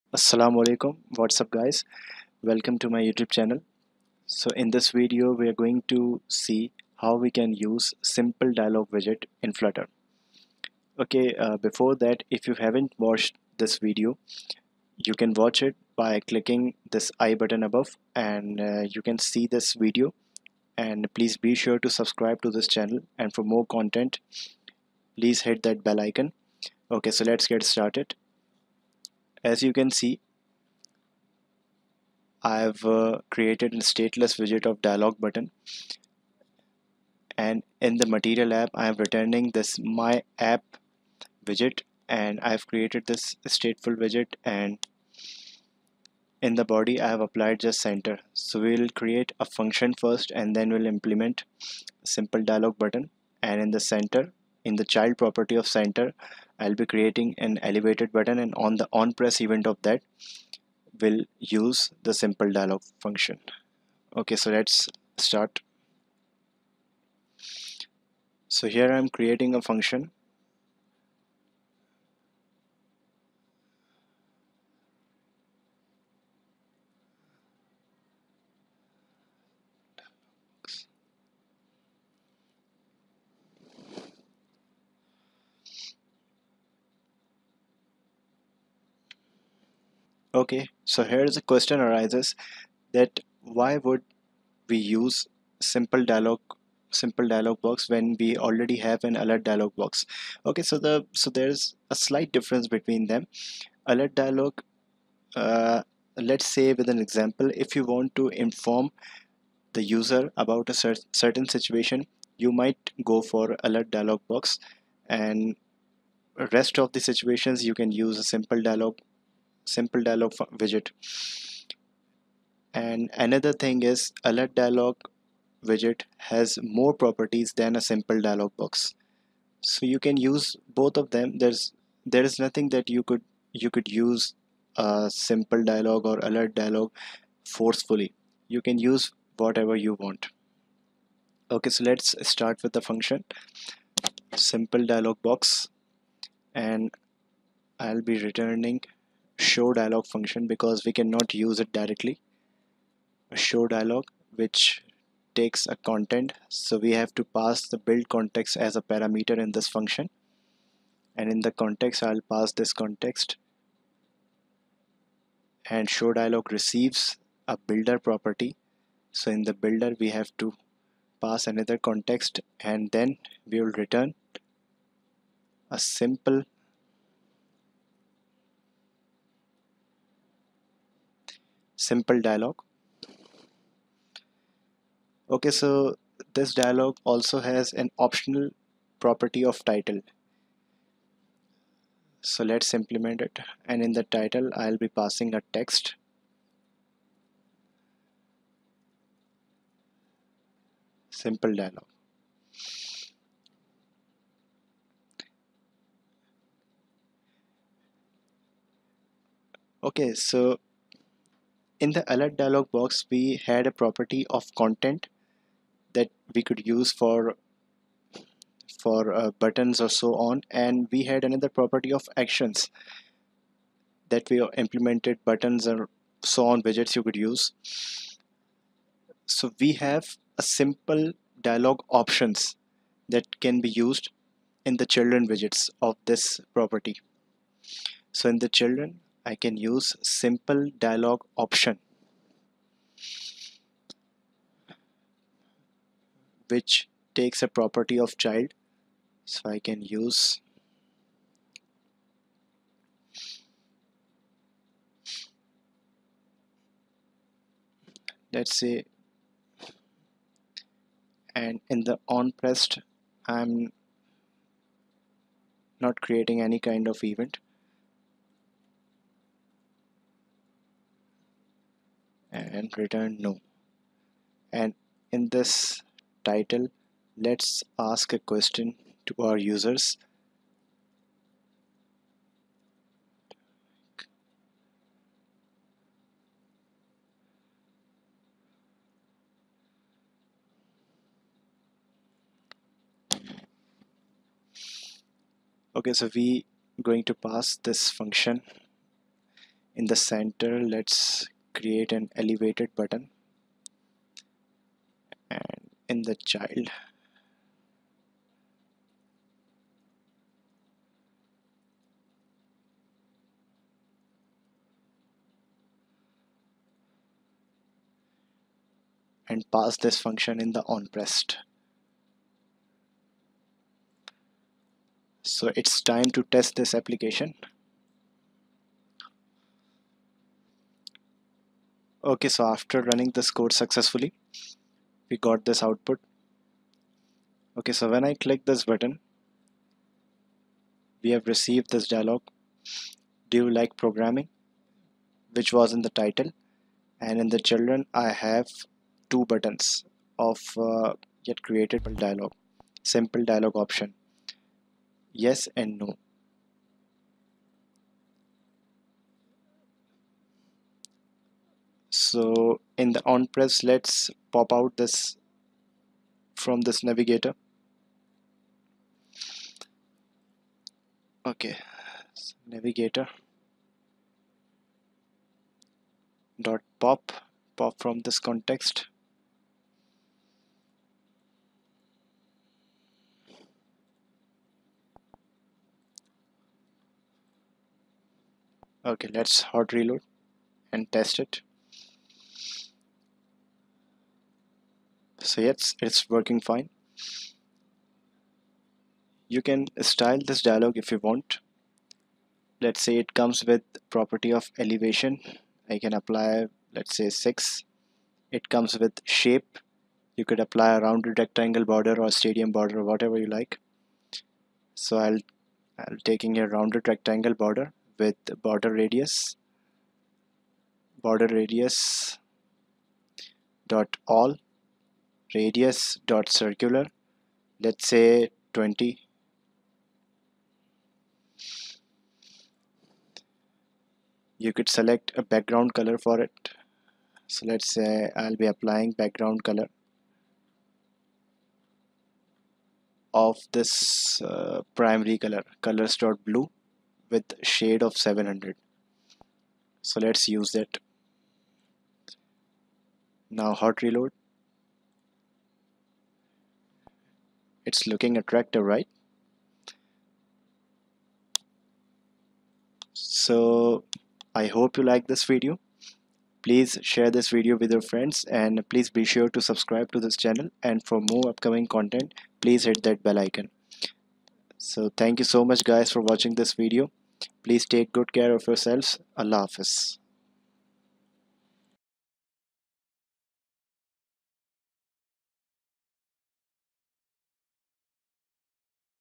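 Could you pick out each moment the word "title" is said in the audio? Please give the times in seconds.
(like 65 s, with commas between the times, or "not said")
189 s, 194 s, 276 s, 345 s.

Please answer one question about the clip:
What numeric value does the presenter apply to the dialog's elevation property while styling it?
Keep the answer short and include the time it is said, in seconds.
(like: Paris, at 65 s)
6, at 407 s.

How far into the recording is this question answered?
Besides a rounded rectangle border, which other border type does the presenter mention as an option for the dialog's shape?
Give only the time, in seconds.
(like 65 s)
412 s.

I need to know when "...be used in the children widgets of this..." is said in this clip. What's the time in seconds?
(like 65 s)
233 s.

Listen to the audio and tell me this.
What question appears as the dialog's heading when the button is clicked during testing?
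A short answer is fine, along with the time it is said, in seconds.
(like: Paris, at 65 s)
do you like programming, at 343 s.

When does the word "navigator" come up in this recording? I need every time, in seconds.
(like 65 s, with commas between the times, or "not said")
366 s, 372 s.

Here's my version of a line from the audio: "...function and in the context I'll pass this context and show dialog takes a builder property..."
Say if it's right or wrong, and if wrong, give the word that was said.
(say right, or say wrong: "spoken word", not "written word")
wrong: "receives", not "takes".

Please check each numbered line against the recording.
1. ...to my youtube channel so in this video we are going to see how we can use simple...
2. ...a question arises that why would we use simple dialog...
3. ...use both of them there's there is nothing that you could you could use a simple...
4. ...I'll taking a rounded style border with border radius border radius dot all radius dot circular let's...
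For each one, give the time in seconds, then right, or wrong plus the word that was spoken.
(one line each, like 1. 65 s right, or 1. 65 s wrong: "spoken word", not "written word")
1. 2 s right
2. 91 s right
3. 130 s right
4. 415 s wrong: "rectangle", not "style".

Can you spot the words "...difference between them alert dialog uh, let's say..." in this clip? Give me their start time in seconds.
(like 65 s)
102 s.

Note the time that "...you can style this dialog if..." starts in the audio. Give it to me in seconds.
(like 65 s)
399 s.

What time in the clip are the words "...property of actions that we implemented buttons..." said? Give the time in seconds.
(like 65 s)
221 s.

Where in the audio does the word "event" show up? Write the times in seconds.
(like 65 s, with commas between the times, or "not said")
59 s, 267 s.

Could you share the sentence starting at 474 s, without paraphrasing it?
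So thank you so much guys for watching this video.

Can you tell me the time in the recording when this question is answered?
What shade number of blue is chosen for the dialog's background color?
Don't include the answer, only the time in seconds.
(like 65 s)
447 s.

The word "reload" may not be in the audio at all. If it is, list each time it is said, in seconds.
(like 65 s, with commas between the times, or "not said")
389 s, 453 s.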